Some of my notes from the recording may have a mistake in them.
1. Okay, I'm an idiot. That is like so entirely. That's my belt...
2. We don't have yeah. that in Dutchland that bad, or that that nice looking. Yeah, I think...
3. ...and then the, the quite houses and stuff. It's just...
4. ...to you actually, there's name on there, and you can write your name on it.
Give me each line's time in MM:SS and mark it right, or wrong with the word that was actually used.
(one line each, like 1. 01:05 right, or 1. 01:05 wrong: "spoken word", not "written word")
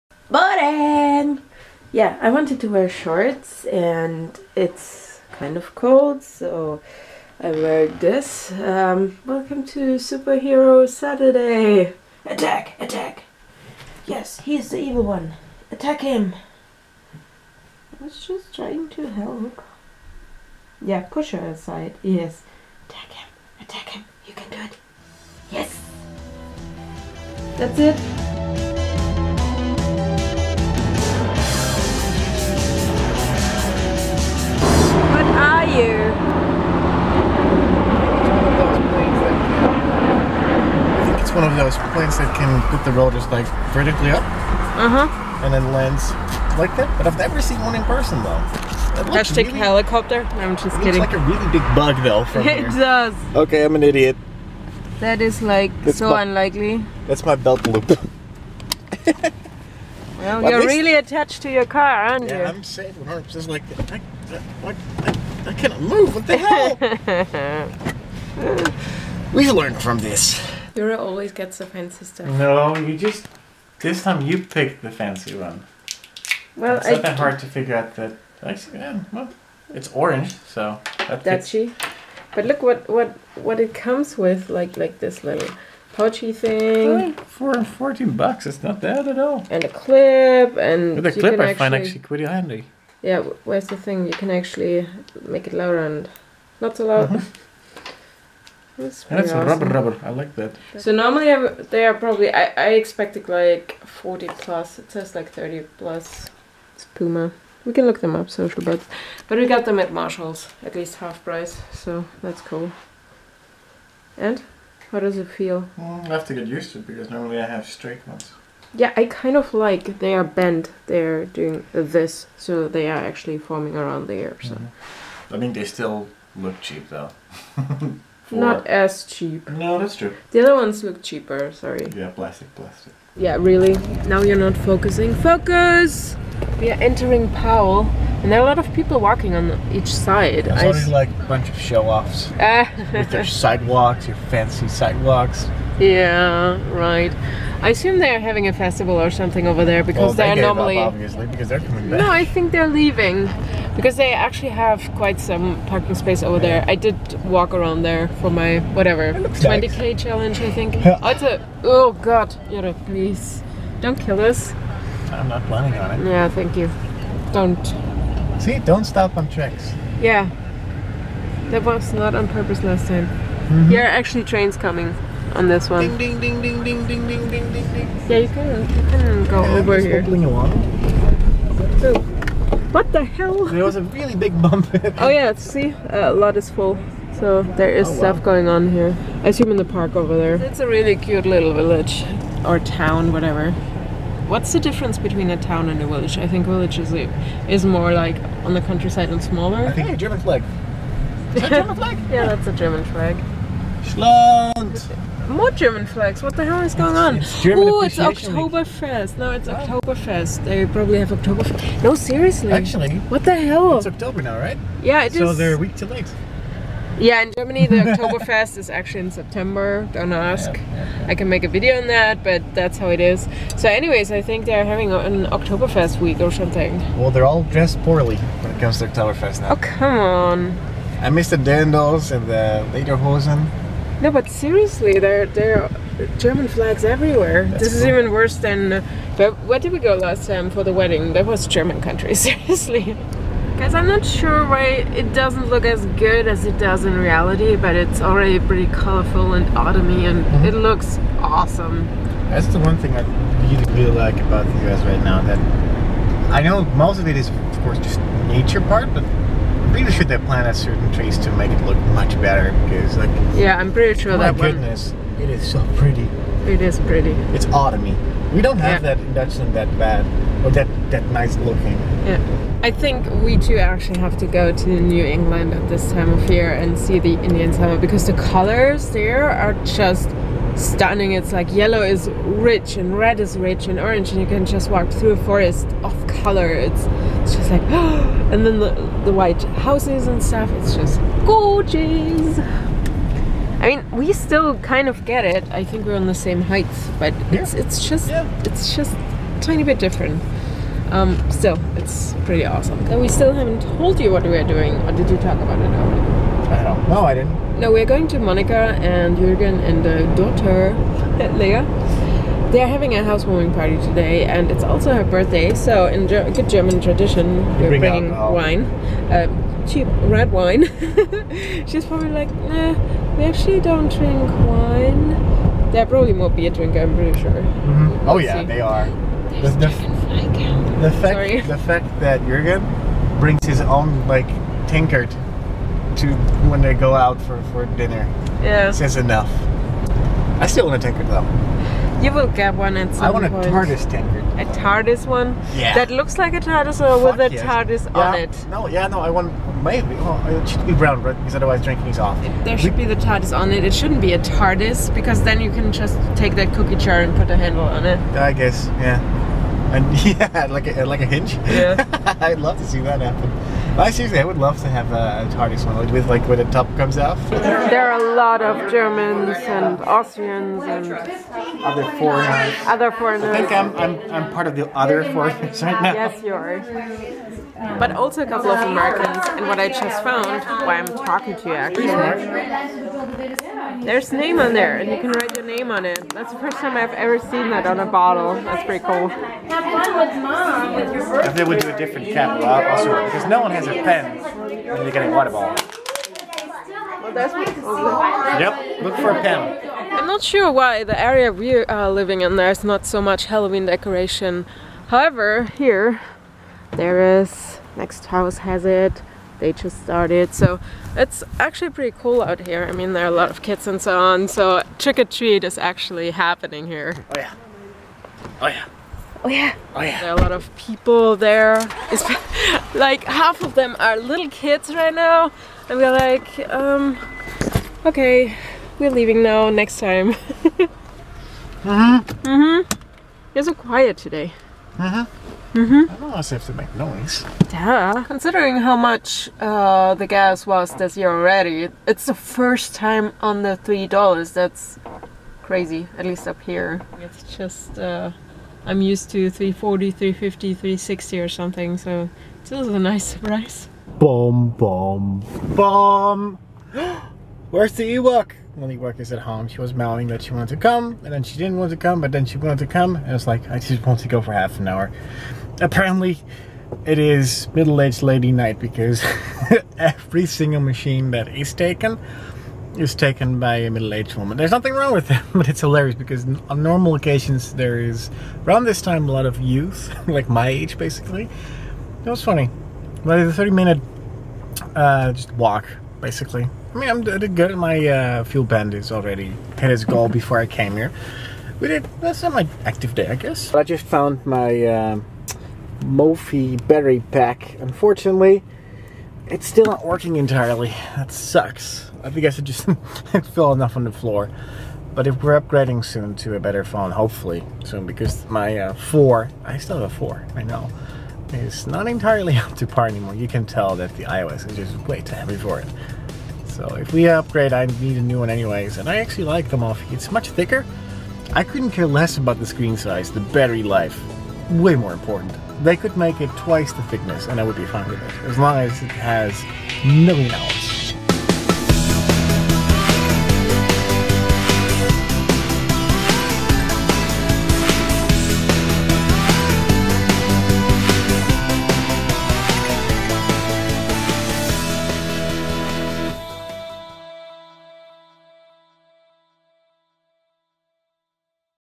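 1. 00:53 wrong: "unlikely", not "entirely"
2. 04:28 right
3. 04:47 wrong: "white", not "quite"
4. 06:21 right.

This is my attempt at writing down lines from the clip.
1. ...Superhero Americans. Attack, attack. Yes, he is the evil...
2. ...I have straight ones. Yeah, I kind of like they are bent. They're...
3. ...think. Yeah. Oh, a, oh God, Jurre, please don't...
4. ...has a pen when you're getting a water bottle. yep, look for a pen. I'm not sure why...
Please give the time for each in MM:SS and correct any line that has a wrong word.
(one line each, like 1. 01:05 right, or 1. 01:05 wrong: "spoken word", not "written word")
1. 00:09 wrong: "Saturday", not "Americans"
2. 01:57 right
3. 02:40 right
4. 06:33 right.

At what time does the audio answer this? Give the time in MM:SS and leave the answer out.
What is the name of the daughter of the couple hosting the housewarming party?
05:11.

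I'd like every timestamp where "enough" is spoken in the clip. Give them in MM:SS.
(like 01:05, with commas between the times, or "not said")
05:38, 08:23.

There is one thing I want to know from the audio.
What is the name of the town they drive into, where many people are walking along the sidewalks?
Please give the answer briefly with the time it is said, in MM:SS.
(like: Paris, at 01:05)
Powell, at 02:17.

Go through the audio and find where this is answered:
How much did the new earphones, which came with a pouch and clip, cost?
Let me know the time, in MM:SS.
01:27.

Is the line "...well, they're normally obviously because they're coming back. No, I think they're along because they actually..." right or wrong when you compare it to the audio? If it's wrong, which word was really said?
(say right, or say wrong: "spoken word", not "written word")
wrong: "leaving", not "along".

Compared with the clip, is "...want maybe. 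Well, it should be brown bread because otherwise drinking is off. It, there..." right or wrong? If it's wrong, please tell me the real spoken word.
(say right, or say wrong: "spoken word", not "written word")
right.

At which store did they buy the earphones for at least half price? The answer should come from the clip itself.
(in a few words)
Marshalls.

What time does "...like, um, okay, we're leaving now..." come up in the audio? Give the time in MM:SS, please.
07:05.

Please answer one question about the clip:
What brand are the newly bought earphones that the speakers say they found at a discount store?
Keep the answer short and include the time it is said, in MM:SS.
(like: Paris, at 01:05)
Puma, at 01:46.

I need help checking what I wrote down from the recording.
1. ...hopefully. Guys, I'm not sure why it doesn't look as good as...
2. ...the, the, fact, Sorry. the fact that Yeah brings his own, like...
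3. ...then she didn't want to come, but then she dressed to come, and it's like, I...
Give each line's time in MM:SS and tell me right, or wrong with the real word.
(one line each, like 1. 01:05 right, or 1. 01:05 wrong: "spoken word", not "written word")
1. 04:02 wrong: "seriously", not "hopefully"
2. 05:29 wrong: "Jurgen", not "Yeah"
3. 07:41 wrong: "wanted", not "dressed".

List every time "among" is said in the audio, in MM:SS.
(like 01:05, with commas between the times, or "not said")
not said.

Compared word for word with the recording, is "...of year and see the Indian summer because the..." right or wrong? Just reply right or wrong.
right.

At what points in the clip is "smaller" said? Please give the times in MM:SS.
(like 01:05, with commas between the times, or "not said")
03:19.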